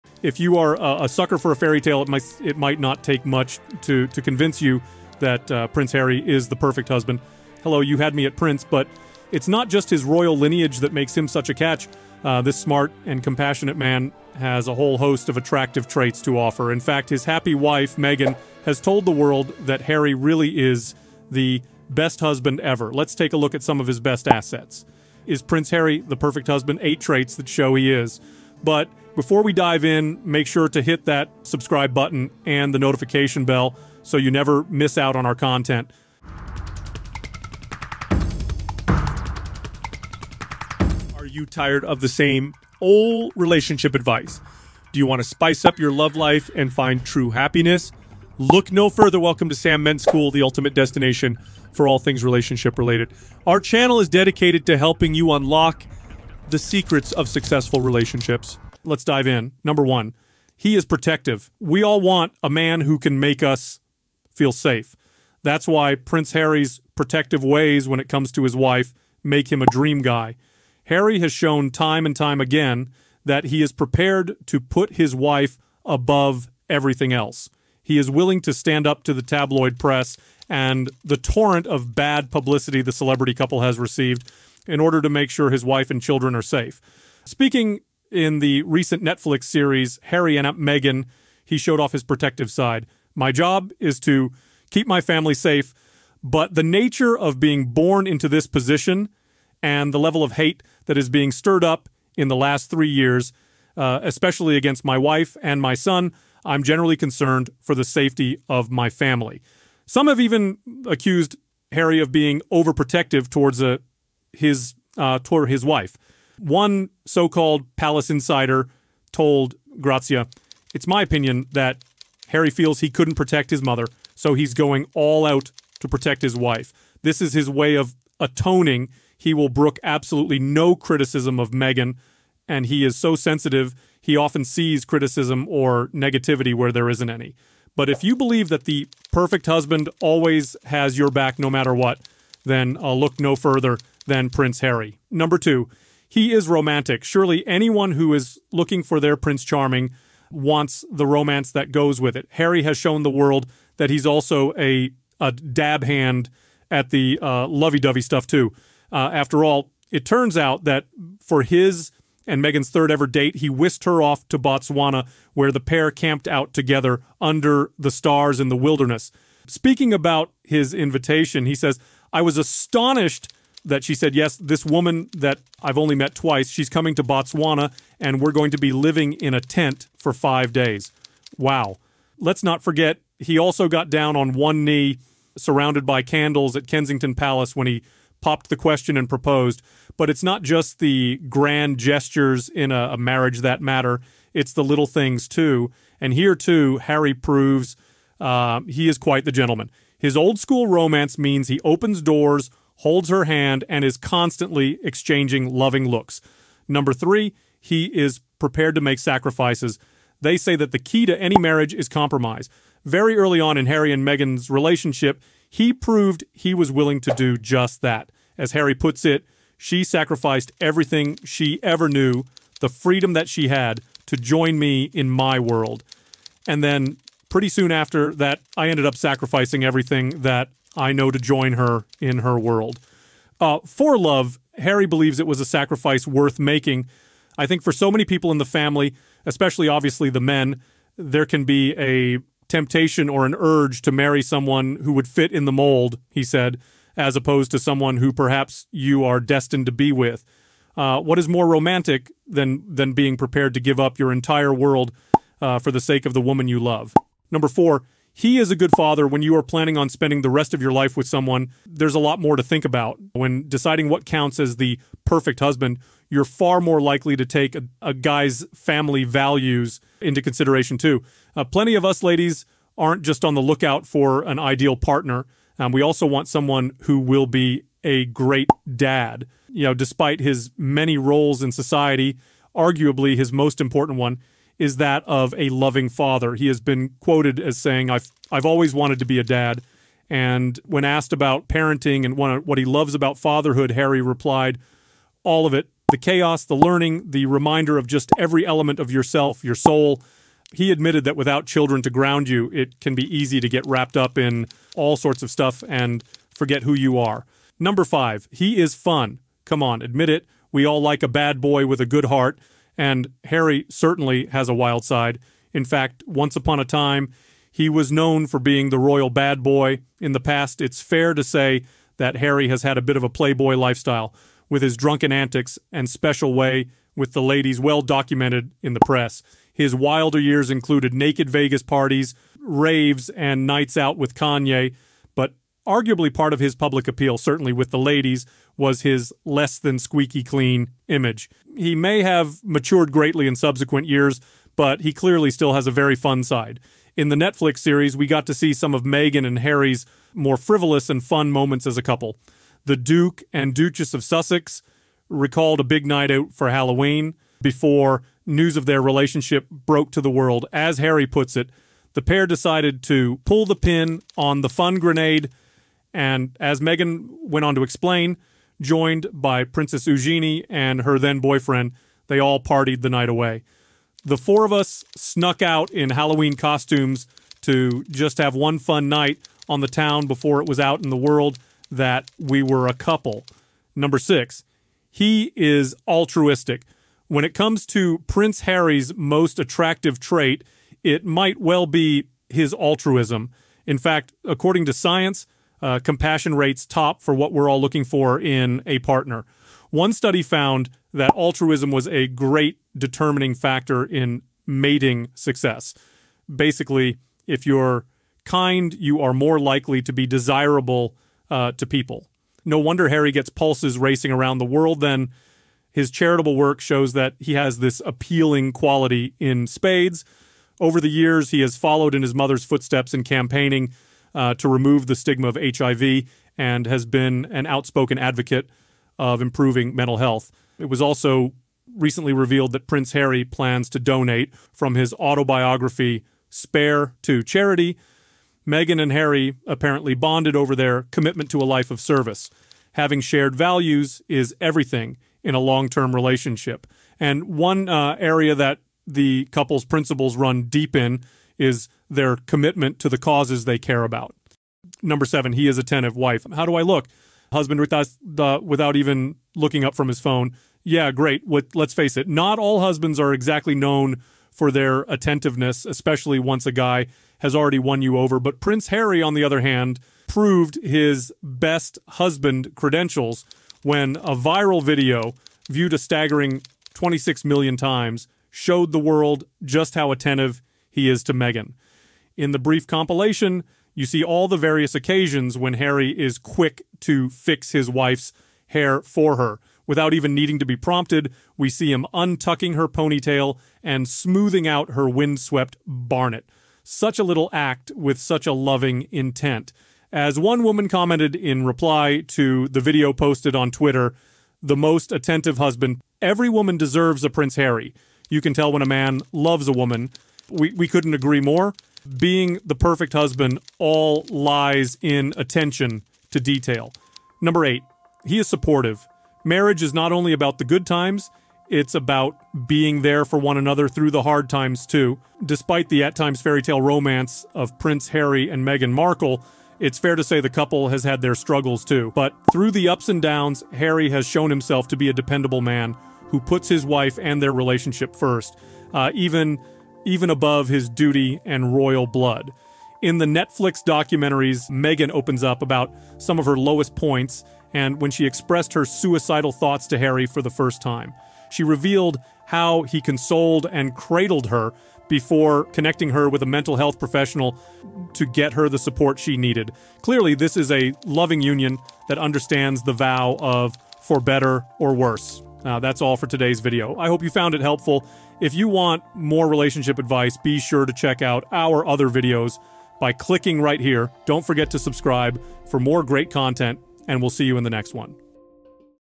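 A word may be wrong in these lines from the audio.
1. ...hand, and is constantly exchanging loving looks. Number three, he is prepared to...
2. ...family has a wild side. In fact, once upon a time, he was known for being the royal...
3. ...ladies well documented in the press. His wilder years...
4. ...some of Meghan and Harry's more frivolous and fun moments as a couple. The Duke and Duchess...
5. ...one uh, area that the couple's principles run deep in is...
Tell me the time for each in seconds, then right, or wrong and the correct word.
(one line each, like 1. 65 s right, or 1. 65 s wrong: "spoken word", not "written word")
1. 203 s right
2. 313 s wrong: "certainly", not "family"
3. 327 s right
4. 348 s right
5. 447 s right.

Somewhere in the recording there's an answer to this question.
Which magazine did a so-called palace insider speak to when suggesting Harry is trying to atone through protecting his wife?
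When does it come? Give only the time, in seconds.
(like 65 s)
119 s.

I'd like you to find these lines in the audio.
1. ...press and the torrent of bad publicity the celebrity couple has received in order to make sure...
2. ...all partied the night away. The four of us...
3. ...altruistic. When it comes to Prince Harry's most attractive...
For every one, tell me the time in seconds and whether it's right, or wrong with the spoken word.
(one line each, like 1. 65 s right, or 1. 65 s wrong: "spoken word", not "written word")
1. 79 s right
2. 372 s right
3. 385 s right.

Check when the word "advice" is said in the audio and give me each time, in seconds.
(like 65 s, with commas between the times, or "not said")
43 s, 569 s.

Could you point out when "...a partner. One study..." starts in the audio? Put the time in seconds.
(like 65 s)
398 s.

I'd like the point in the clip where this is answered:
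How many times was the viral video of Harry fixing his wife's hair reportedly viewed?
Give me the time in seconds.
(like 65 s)
476 s.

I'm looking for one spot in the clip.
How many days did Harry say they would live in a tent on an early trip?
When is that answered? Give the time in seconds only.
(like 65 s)
180 s.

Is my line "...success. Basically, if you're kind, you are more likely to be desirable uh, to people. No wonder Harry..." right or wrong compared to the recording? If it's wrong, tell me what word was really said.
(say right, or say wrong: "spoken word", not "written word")
right.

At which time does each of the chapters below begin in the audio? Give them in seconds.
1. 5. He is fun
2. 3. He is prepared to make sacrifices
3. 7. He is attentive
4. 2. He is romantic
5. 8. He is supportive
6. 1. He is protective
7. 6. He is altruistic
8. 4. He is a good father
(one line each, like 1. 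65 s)
1. 307 s
2. 207 s
3. 454 s
4. 145 s
5. 516 s
6. 59 s
7. 384 s
8. 257 s.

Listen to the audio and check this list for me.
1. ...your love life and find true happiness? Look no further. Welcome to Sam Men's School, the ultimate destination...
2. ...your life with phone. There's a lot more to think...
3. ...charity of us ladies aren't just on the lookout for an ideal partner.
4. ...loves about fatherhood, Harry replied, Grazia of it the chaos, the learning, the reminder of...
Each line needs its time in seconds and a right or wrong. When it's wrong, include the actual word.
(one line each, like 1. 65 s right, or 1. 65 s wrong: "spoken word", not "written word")
1. 45 s right
2. 260 s wrong: "someone", not "phone"
3. 271 s wrong: "plenty", not "charity"
4. 292 s wrong: "All", not "Grazia".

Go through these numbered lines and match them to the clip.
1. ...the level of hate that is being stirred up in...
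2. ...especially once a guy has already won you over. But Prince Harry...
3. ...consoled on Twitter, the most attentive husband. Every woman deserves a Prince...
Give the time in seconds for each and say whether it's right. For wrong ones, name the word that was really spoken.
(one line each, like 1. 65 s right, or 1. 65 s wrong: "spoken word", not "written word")
1. 99 s right
2. 465 s right
3. 502 s wrong: "posted", not "consoled".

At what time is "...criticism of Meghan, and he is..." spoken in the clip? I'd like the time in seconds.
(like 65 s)
130 s.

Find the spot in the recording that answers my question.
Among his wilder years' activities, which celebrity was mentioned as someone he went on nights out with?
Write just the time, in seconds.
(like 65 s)
334 s.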